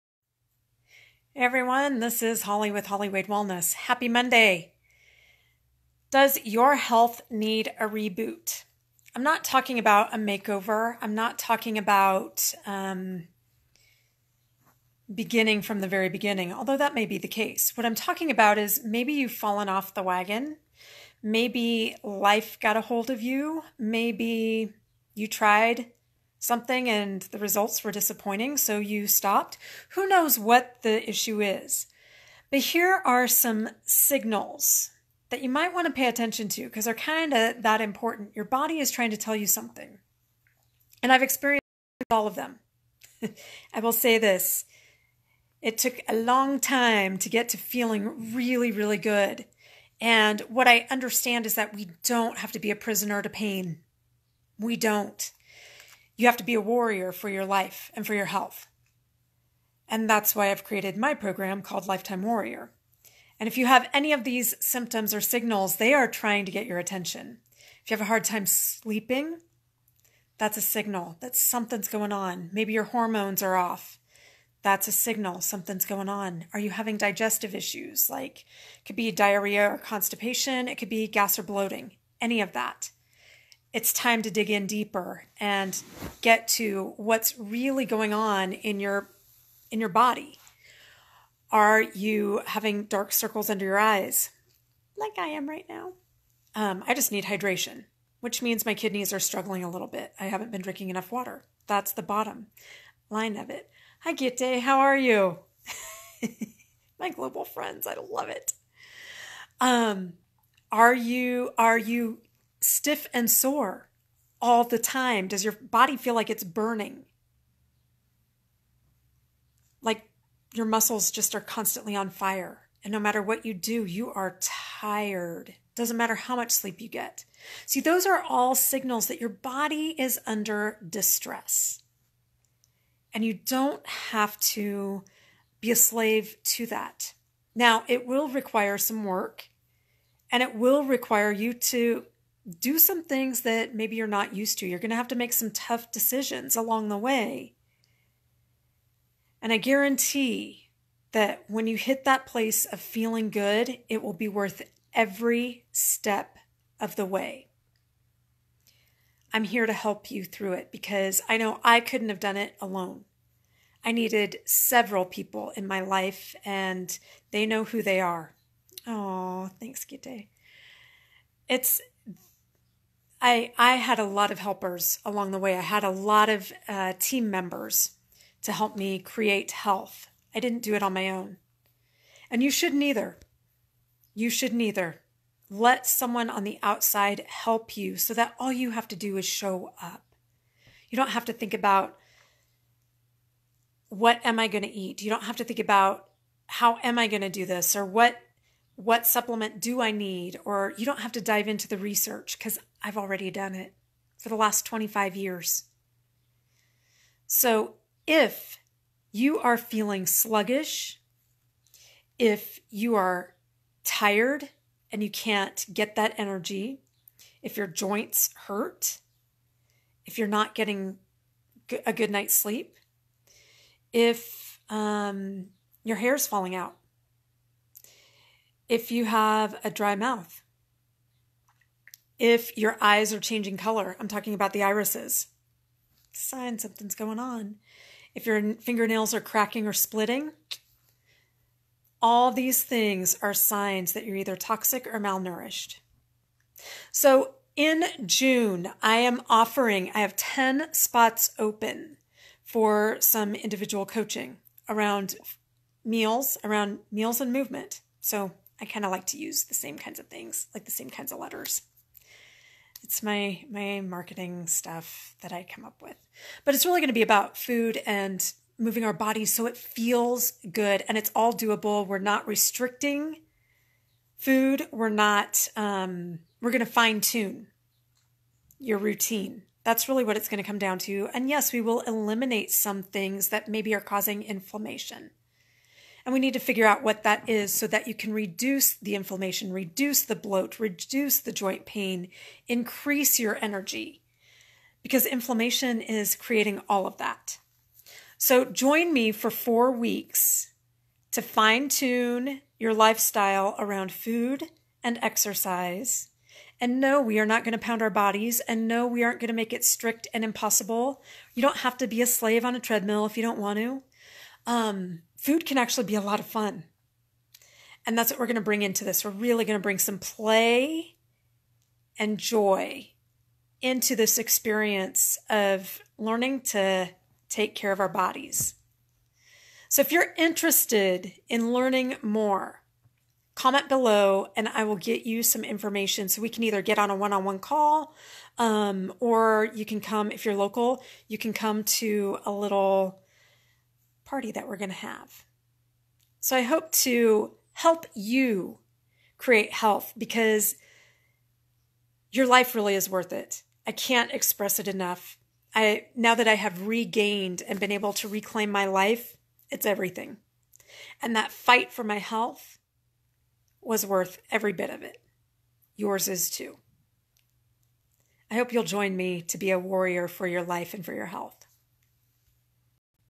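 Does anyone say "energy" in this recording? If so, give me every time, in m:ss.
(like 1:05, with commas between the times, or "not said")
3:36, 4:53.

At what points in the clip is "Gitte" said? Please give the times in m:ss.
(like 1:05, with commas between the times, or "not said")
1:44, 2:49.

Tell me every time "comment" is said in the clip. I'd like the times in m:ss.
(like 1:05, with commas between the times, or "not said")
5:33.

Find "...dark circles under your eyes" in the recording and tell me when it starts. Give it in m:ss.
1:32.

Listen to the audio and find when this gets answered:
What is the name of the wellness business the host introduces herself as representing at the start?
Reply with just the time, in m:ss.
0:02.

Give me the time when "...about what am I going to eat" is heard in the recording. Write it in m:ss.
3:11.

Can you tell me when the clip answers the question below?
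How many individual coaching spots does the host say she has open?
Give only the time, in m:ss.
4:10.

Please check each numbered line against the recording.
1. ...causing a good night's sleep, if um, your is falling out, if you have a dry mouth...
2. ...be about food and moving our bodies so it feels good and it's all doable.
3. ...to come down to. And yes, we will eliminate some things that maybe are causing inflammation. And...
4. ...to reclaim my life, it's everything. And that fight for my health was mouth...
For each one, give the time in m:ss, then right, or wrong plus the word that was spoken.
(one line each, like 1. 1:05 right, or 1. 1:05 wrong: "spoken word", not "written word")
1. 3:40 wrong: "getting", not "causing"
2. 4:26 right
3. 4:40 right
4. 5:57 wrong: "worth", not "mouth".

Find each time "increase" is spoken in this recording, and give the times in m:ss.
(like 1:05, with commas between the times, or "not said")
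4:52.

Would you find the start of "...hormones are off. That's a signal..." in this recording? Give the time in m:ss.
1:12.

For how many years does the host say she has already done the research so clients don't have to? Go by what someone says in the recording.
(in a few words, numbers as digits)
25.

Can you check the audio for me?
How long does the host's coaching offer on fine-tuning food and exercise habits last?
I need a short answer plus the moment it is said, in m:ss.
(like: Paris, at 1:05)
4 weeks, at 4:59.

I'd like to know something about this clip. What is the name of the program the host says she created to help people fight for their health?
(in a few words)
Lifetime Warrior.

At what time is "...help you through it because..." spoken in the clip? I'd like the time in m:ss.
2:39.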